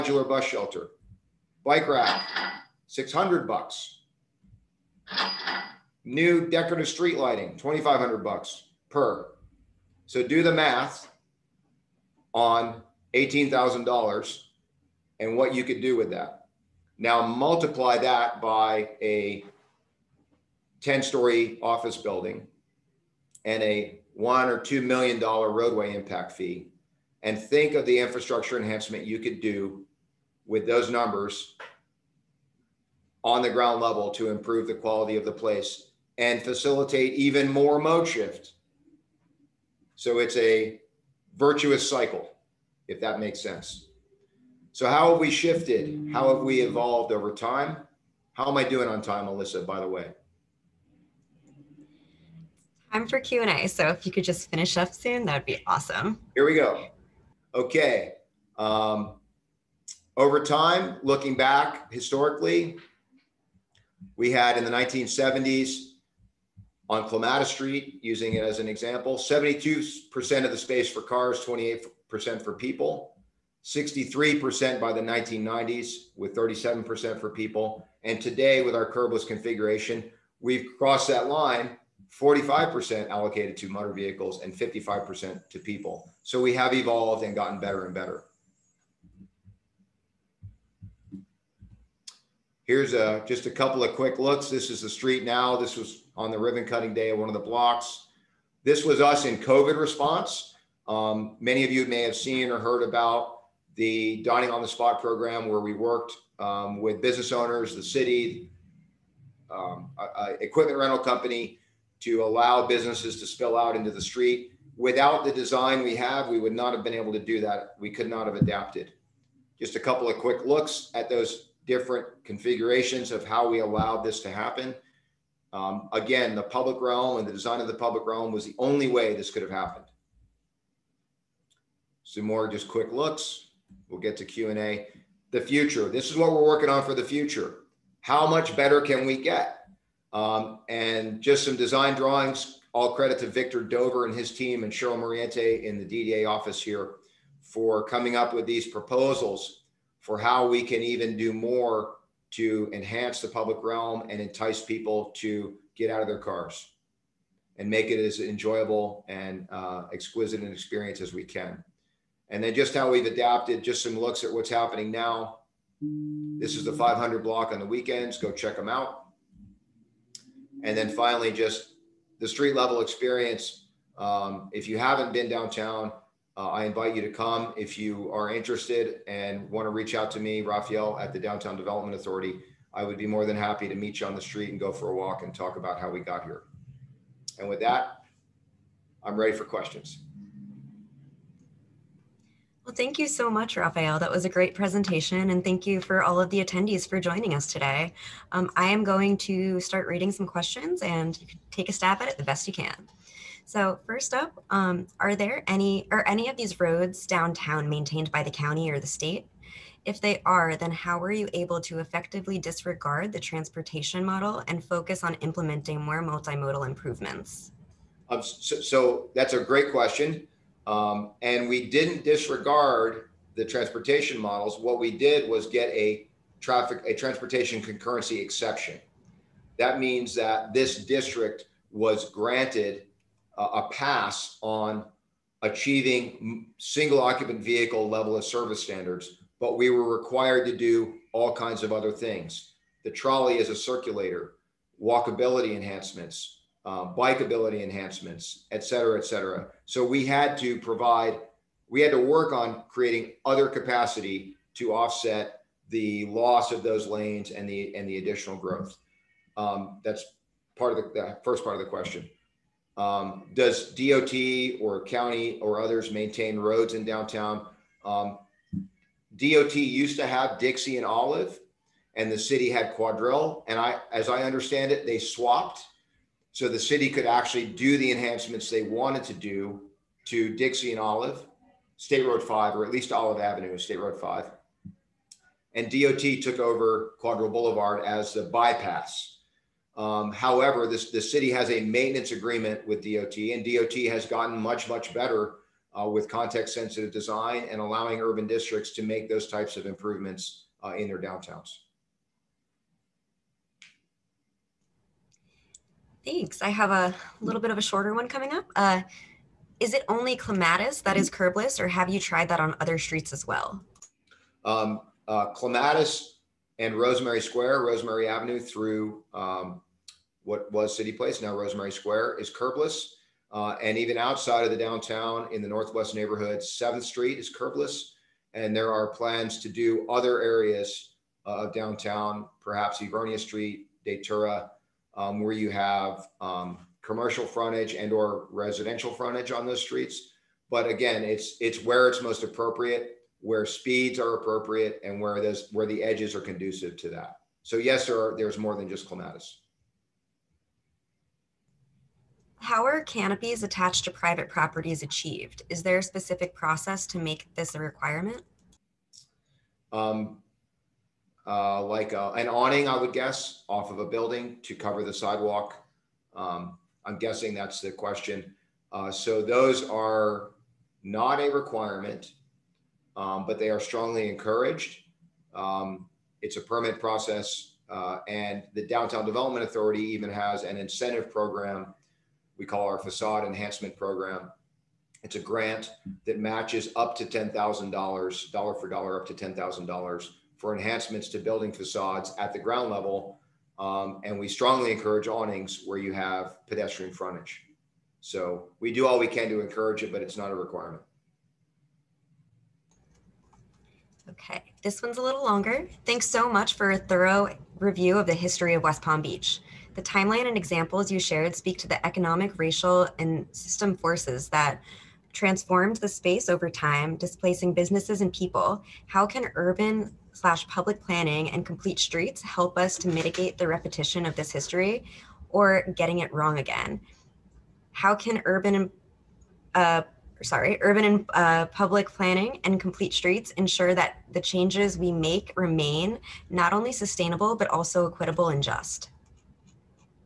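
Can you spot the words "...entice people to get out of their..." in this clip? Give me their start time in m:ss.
2:34.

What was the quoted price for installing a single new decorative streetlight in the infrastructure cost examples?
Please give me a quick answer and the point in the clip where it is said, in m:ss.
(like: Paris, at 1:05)
$2,500, at 0:07.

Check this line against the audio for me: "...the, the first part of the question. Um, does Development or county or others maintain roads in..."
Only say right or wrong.
wrong.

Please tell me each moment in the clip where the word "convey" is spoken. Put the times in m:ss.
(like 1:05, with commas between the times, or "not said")
not said.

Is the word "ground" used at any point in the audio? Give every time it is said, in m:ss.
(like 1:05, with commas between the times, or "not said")
0:33, 6:32.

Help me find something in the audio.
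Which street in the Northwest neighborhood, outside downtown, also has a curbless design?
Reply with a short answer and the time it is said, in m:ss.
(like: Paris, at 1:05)
7th Street, at 5:26.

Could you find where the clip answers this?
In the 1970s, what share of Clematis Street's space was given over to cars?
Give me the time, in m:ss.
1:09.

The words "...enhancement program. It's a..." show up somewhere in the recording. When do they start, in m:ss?
6:23.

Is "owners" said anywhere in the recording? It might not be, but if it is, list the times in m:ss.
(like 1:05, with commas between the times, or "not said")
1:47.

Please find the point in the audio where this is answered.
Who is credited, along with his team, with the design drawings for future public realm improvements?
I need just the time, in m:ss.
2:23.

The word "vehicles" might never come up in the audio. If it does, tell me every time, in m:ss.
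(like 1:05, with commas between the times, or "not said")
1:23, 3:57.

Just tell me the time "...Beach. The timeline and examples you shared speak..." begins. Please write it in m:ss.
6:49.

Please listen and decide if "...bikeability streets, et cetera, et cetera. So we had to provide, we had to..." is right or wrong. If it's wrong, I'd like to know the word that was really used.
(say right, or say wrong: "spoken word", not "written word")
wrong: "enhancements", not "streets".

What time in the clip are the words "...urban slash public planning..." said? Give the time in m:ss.
6:59.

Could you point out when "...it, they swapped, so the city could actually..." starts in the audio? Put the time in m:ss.
4:34.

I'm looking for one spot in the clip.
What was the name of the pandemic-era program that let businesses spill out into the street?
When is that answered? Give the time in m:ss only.
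1:44.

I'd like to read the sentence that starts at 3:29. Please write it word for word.
If they are, then how were you able to effectively disregard the transportation model and focus on implementing more multimodal improvements?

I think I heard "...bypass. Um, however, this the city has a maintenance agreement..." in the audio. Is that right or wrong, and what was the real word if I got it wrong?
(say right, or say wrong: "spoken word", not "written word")
right.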